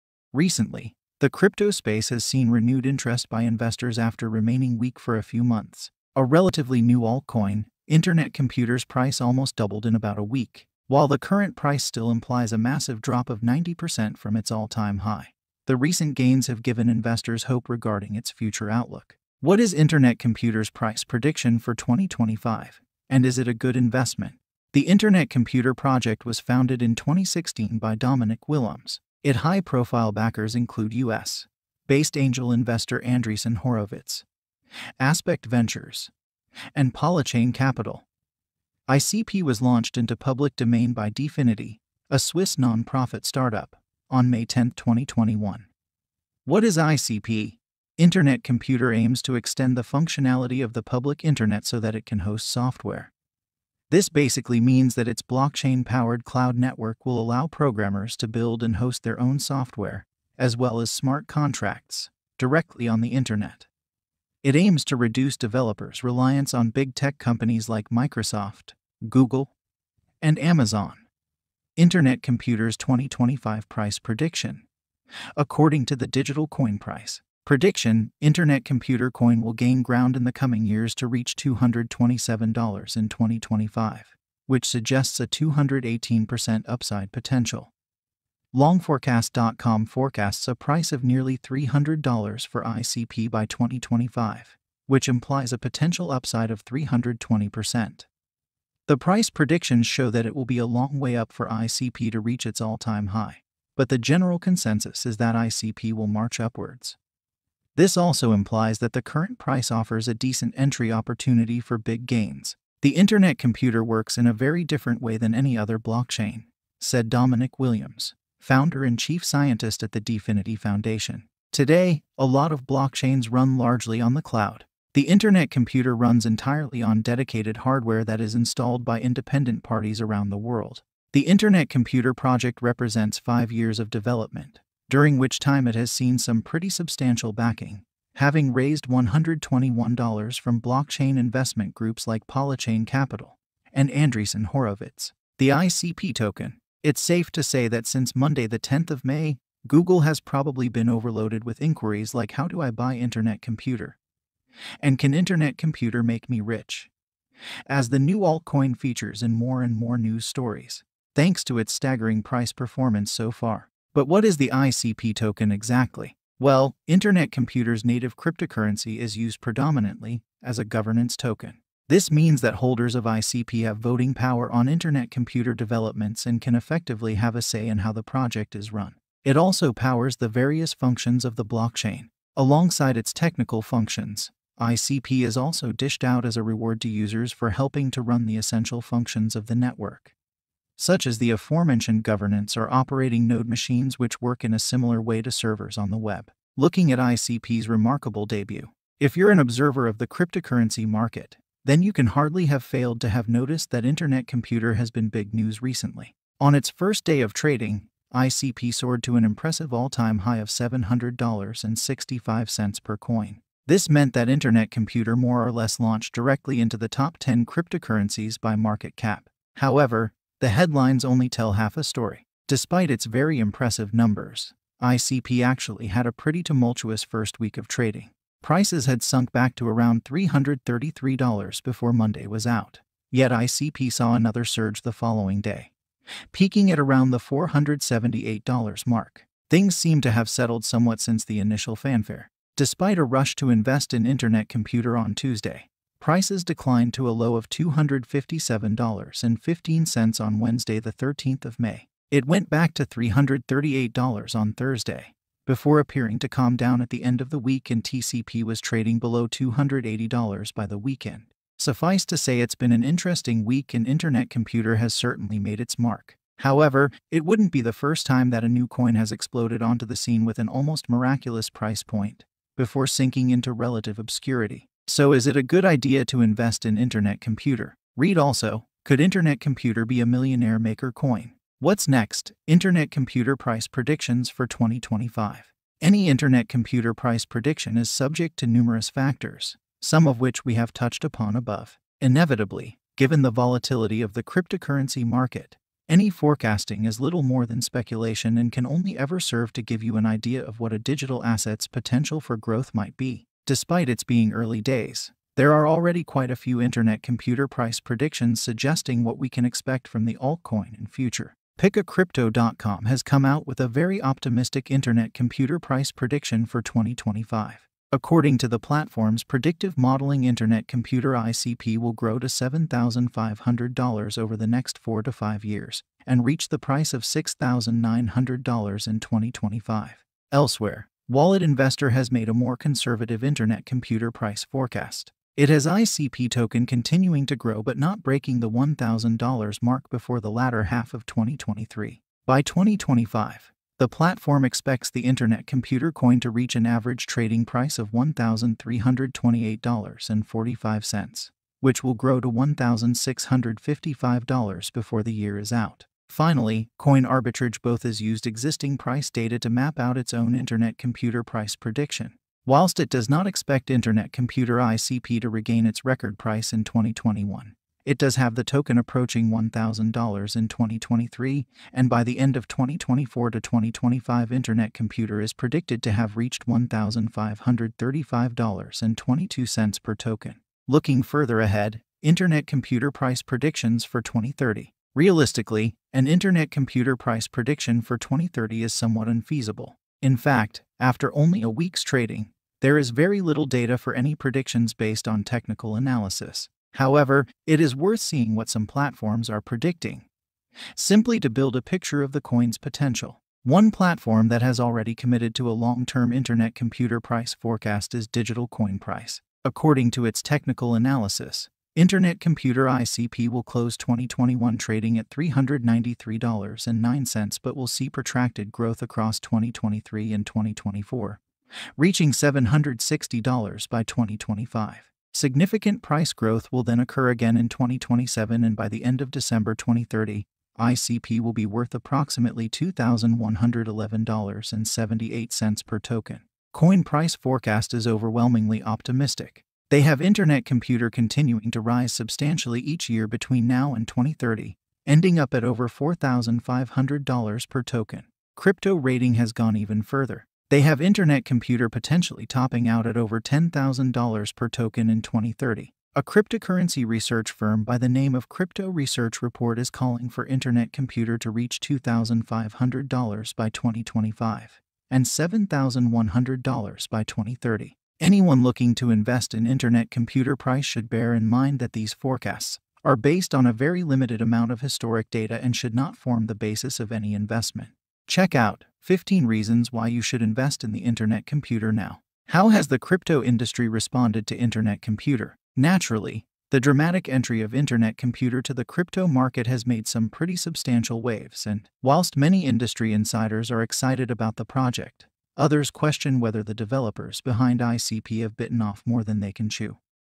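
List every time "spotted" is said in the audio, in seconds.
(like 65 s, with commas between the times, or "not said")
not said.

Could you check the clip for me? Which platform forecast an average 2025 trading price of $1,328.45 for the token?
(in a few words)
Wallet Investor.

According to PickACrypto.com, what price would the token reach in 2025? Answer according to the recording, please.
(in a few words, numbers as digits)
$6,900.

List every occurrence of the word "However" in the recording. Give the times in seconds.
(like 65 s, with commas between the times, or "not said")
219 s, 266 s, 396 s.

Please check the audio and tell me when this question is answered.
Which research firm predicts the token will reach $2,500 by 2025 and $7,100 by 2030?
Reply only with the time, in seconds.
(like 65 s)
458 s.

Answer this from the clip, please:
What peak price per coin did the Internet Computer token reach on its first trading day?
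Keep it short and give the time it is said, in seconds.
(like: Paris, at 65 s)
$700.65, at 210 s.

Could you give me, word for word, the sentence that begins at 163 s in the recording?
But what is the ICP token exactly?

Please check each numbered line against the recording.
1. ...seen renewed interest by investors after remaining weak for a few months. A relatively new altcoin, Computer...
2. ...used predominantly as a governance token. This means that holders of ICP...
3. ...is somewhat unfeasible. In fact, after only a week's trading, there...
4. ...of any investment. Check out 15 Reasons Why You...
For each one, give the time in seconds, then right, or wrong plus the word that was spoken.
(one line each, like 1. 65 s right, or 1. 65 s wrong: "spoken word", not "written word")
1. 2 s wrong: "Internet", not "Computer"
2. 169 s right
3. 388 s right
4. 476 s right.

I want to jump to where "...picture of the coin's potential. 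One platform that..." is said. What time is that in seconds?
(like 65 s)
401 s.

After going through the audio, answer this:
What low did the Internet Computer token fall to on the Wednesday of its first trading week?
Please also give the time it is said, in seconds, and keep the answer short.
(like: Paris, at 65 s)
$257.15, at 247 s.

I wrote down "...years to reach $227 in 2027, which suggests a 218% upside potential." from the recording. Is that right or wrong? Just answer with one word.
wrong.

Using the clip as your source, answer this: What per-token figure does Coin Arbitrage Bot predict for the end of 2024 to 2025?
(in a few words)
$1,535.22.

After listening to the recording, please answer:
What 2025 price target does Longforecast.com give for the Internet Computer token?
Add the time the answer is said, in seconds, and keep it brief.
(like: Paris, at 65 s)
nearly $300, at 91 s.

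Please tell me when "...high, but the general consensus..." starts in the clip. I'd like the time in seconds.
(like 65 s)
103 s.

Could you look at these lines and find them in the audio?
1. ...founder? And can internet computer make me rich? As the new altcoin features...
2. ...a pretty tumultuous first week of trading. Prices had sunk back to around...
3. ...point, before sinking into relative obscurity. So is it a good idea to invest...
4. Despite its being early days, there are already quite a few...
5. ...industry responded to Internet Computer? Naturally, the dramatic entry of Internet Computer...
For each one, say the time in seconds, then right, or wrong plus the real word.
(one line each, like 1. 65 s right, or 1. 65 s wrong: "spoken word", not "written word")
1. 153 s wrong: "computer", not "founder"
2. 226 s right
3. 271 s right
4. 303 s right
5. 483 s right.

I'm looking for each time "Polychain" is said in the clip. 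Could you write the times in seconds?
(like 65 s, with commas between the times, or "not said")
36 s, 142 s.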